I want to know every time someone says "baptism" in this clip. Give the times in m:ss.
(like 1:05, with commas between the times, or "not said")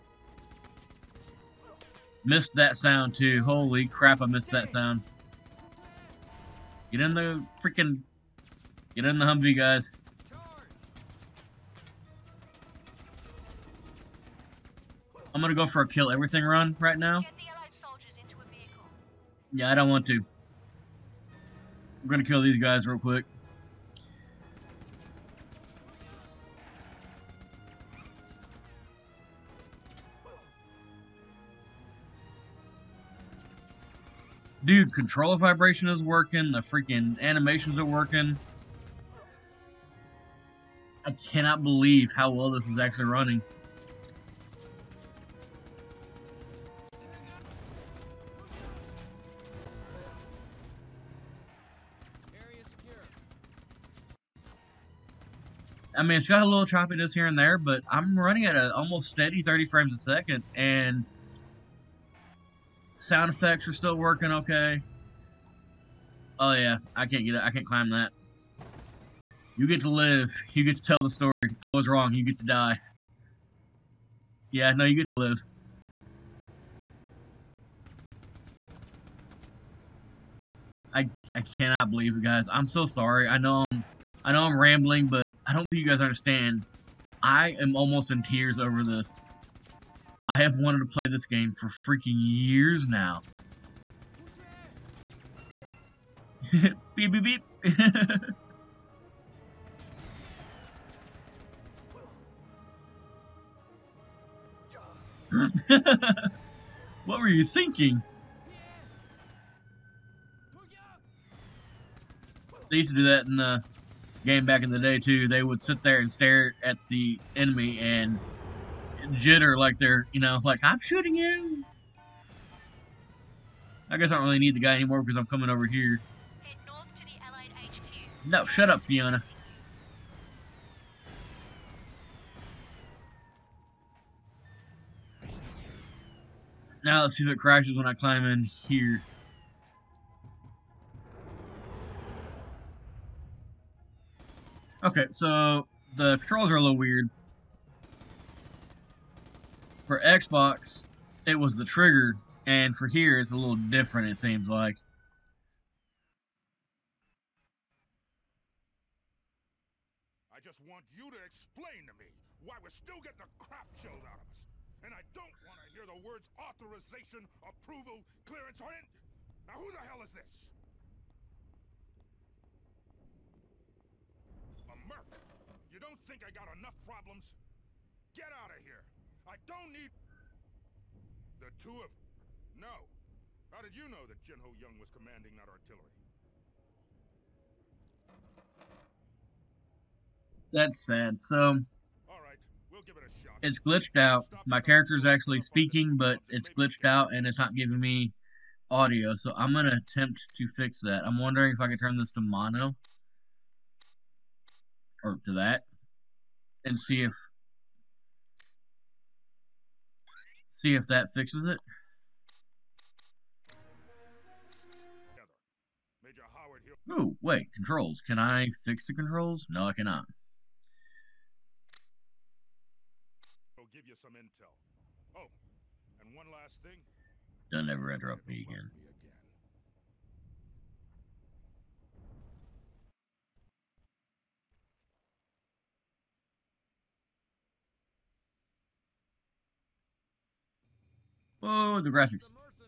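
not said.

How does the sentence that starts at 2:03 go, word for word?
I guess I don't really need the guy anymore because I'm coming over here.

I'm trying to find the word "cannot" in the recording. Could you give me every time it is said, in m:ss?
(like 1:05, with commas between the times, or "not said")
0:41, 1:21, 3:39.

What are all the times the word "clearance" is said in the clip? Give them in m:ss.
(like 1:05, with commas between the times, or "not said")
2:48.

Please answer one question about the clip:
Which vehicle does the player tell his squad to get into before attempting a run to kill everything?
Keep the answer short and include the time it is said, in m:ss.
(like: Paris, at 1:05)
Humvee, at 0:09.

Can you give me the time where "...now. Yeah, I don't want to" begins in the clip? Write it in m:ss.
0:16.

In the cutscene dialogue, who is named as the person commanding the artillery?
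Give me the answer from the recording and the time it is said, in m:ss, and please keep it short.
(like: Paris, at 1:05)
Jin Ho Young, at 3:04.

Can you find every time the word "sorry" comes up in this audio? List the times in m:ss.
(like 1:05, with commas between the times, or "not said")
1:22.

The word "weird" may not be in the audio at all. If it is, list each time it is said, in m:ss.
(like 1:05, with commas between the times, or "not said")
2:26.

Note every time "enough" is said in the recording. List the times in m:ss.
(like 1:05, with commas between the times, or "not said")
2:56.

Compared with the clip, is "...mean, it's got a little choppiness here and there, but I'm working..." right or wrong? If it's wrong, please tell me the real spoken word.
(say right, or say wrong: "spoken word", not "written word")
wrong: "running", not "working".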